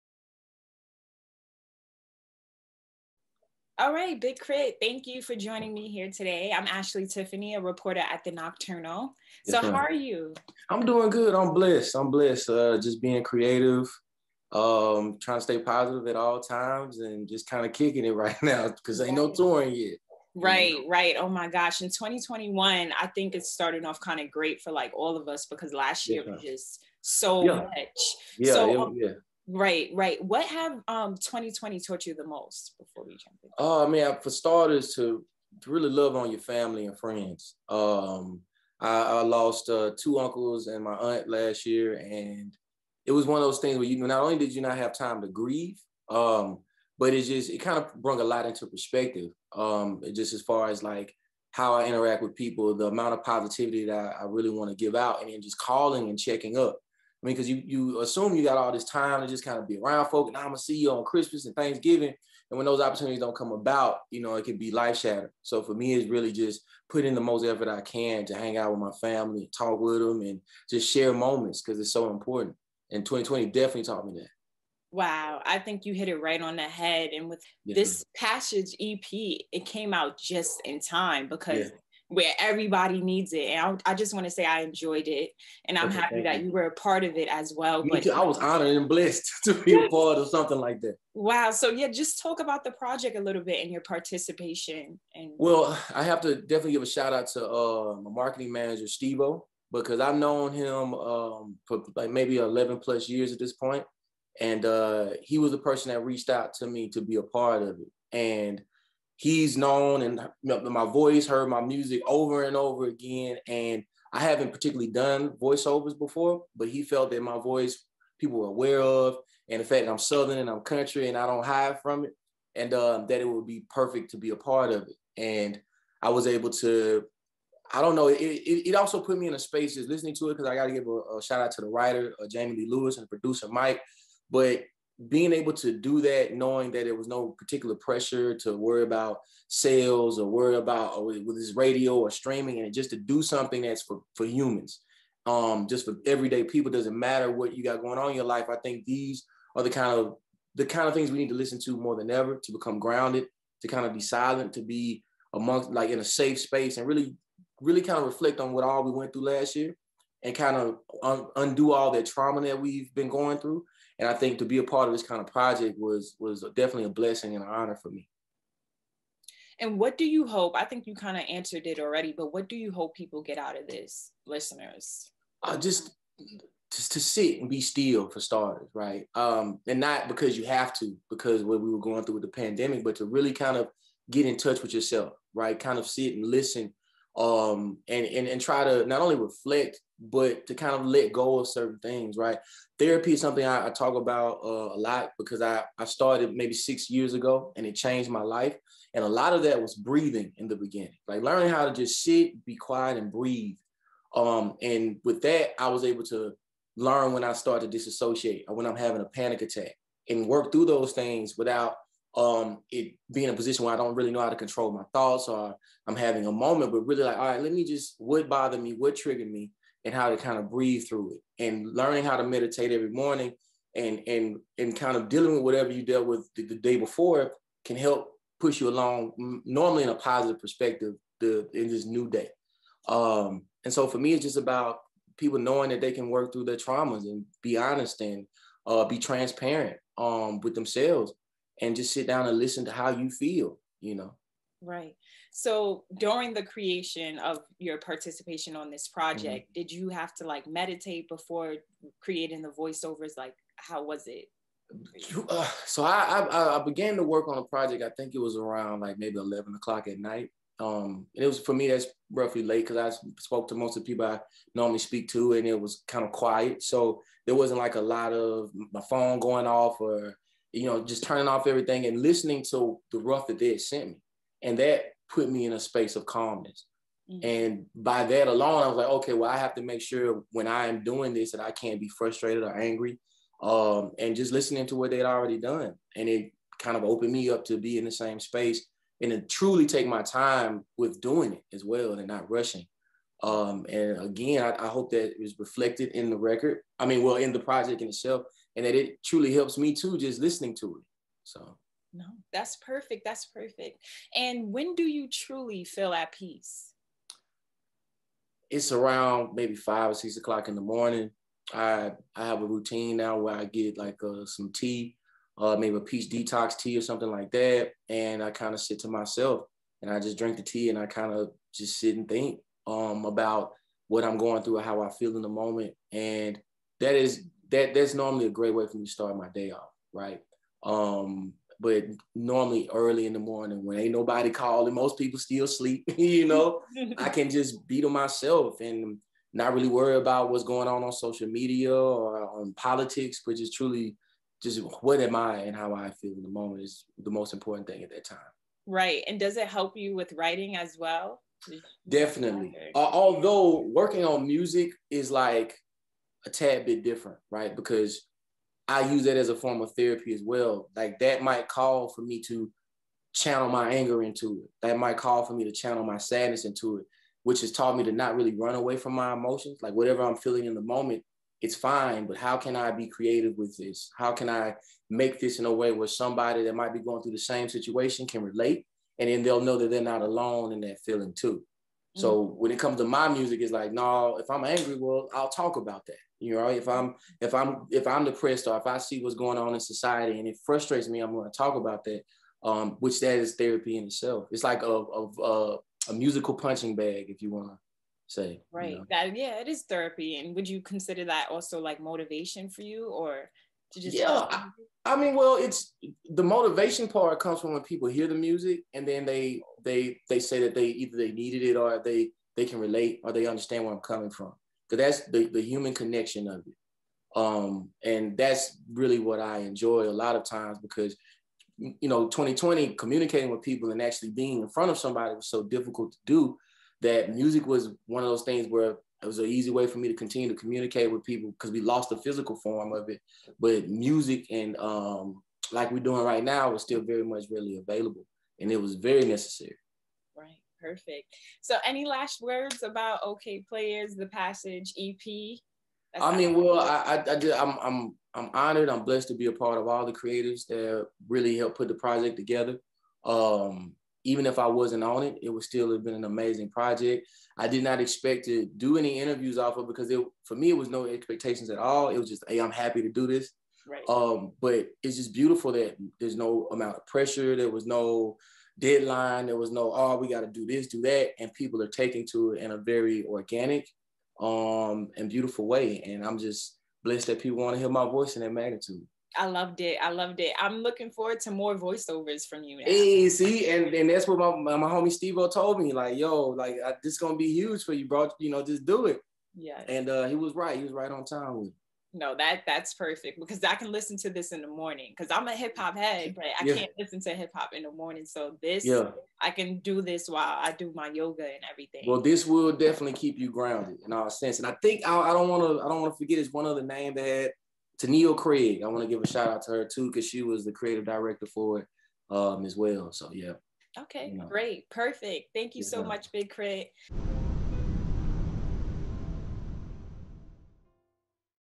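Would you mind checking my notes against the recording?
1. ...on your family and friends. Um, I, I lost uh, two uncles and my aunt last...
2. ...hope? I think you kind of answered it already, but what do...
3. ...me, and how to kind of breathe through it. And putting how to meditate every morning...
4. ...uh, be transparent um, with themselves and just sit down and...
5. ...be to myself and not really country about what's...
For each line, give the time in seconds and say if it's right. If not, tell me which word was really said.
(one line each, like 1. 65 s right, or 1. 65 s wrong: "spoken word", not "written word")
1. 36 s right
2. 170 s right
3. 219 s wrong: "learning", not "putting"
4. 238 s right
5. 337 s wrong: "worry", not "country".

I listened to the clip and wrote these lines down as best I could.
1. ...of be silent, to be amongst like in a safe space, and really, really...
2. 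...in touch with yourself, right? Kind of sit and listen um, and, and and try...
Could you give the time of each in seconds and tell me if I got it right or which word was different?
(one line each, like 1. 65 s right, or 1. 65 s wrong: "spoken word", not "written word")
1. 153 s right
2. 184 s right.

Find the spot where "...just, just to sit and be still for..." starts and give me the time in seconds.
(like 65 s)
175 s.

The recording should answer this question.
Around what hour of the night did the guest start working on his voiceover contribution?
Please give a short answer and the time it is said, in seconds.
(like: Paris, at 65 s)
11 o'clock, at 259 s.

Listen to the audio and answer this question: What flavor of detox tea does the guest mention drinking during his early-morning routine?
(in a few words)
Peach.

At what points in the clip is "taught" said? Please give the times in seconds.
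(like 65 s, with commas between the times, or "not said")
31 s, 73 s, 367 s.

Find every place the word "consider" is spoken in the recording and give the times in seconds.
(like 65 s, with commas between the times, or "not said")
400 s.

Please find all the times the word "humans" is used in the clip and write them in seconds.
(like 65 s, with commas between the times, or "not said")
144 s, 415 s.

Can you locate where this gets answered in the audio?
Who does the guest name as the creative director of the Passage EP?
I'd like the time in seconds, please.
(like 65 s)
507 s.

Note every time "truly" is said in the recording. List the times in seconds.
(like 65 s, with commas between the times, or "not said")
289 s, 299 s, 305 s, 343 s.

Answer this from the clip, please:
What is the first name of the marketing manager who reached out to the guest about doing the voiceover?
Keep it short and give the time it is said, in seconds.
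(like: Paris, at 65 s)
Stevo, at 98 s.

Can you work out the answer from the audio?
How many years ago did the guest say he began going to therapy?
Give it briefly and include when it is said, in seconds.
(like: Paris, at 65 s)
6, at 196 s.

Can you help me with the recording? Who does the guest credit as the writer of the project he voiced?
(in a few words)
Jamie Lee Lewis.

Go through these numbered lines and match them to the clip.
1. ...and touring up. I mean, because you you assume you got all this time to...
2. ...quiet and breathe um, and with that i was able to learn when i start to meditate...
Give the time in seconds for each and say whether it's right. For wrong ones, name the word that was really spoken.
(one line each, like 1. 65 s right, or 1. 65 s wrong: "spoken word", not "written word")
1. 56 s wrong: "checking", not "touring"
2. 202 s wrong: "disassociate", not "meditate".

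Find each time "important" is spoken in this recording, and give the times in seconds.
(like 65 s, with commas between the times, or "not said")
72 s, 347 s.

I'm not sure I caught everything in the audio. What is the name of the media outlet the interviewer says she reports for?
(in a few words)
The Knockturnal.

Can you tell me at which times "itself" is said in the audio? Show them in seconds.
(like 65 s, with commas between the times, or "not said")
297 s, 393 s.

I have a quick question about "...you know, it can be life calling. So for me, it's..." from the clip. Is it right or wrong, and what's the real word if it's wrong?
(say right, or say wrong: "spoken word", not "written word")
wrong: "shattering", not "calling".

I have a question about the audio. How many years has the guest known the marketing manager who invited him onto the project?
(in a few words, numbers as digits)
11.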